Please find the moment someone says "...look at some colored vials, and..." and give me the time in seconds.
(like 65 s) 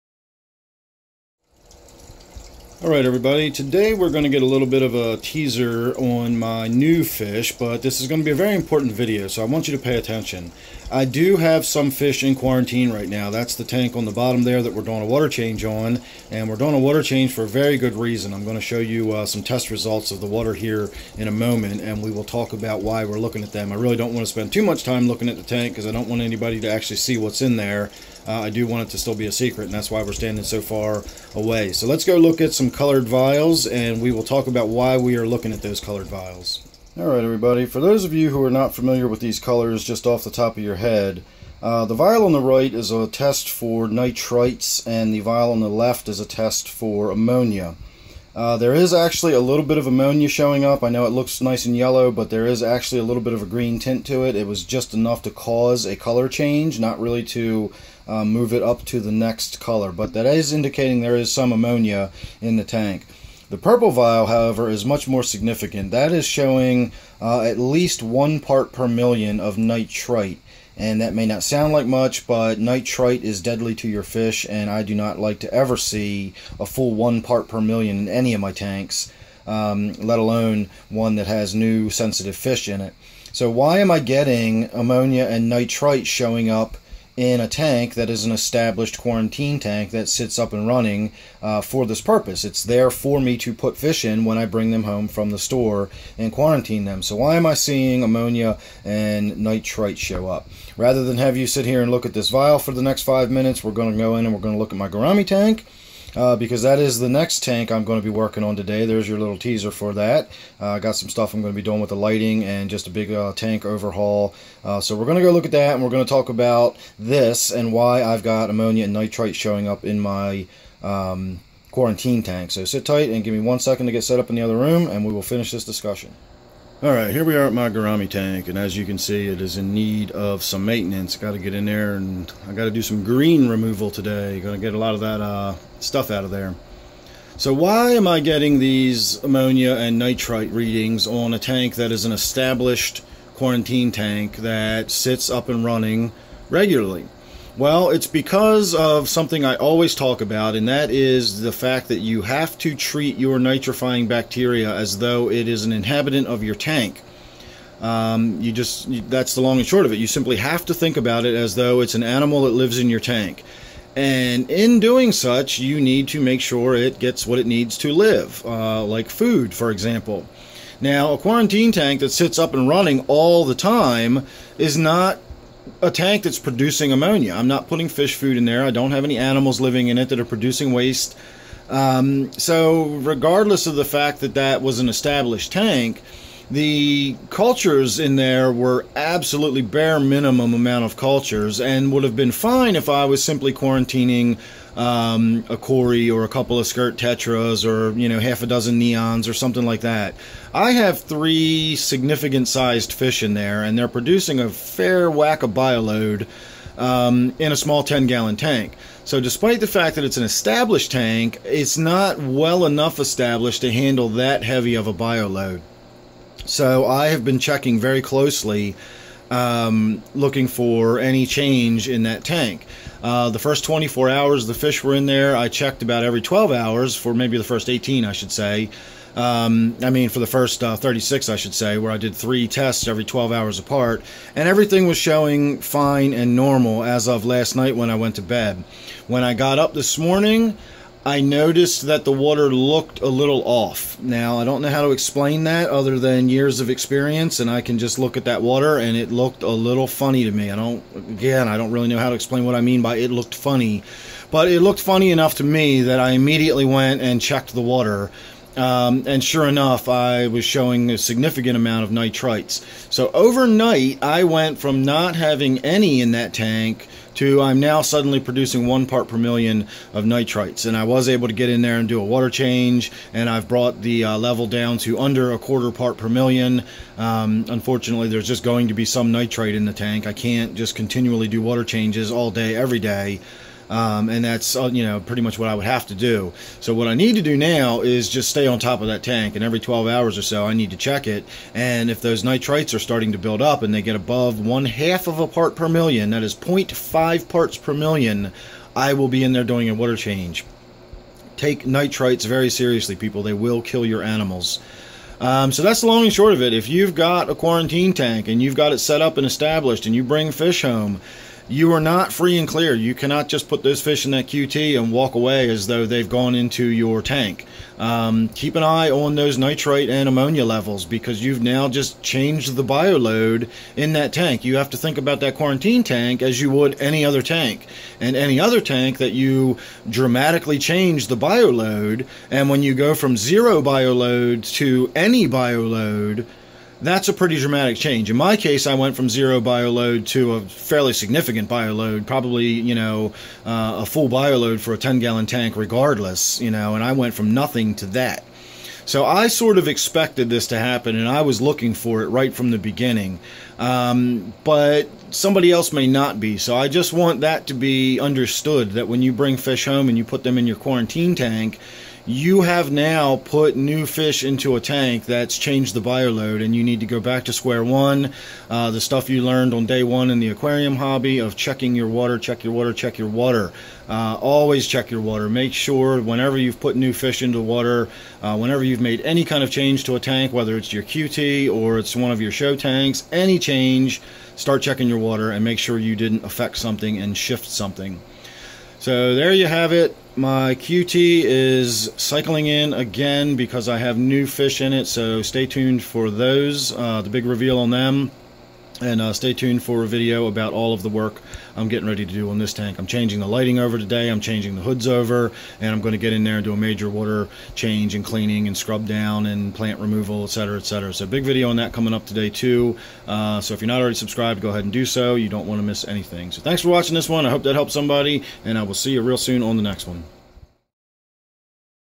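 32 s.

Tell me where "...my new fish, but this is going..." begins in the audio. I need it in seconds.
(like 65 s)
6 s.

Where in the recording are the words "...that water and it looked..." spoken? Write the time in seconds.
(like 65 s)
248 s.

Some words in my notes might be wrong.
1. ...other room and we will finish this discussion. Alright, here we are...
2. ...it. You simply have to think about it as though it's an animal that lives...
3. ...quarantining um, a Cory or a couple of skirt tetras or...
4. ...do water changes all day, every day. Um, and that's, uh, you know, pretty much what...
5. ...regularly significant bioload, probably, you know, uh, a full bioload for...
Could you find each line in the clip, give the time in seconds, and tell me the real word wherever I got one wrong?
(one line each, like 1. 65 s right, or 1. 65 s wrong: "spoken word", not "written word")
1. 124 s right
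2. 159 s right
3. 193 s right
4. 281 s right
5. 340 s wrong: "fairly", not "regularly".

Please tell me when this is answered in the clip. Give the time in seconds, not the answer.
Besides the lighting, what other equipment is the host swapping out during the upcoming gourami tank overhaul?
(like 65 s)
404 s.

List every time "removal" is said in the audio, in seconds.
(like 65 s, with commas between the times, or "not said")
133 s, 409 s.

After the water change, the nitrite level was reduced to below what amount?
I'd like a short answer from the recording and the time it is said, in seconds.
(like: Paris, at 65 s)
A quarter part per million, at 275 s.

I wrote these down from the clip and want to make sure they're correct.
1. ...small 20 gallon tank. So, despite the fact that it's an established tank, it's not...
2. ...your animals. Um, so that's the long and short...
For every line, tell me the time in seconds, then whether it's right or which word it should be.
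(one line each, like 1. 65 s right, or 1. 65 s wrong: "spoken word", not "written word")
1. 207 s wrong: "10", not "20"
2. 303 s right.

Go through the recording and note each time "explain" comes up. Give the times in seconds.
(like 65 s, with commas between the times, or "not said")
244 s, 252 s.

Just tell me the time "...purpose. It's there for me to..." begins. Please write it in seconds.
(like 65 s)
92 s.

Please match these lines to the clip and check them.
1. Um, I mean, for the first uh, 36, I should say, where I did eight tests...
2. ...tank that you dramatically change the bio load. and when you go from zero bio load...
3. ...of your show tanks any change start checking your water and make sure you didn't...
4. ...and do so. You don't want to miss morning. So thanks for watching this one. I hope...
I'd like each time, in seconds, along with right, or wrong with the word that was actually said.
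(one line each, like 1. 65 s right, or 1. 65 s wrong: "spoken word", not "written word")
1. 229 s wrong: "three", not "eight"
2. 328 s right
3. 382 s right
4. 414 s wrong: "anything", not "morning".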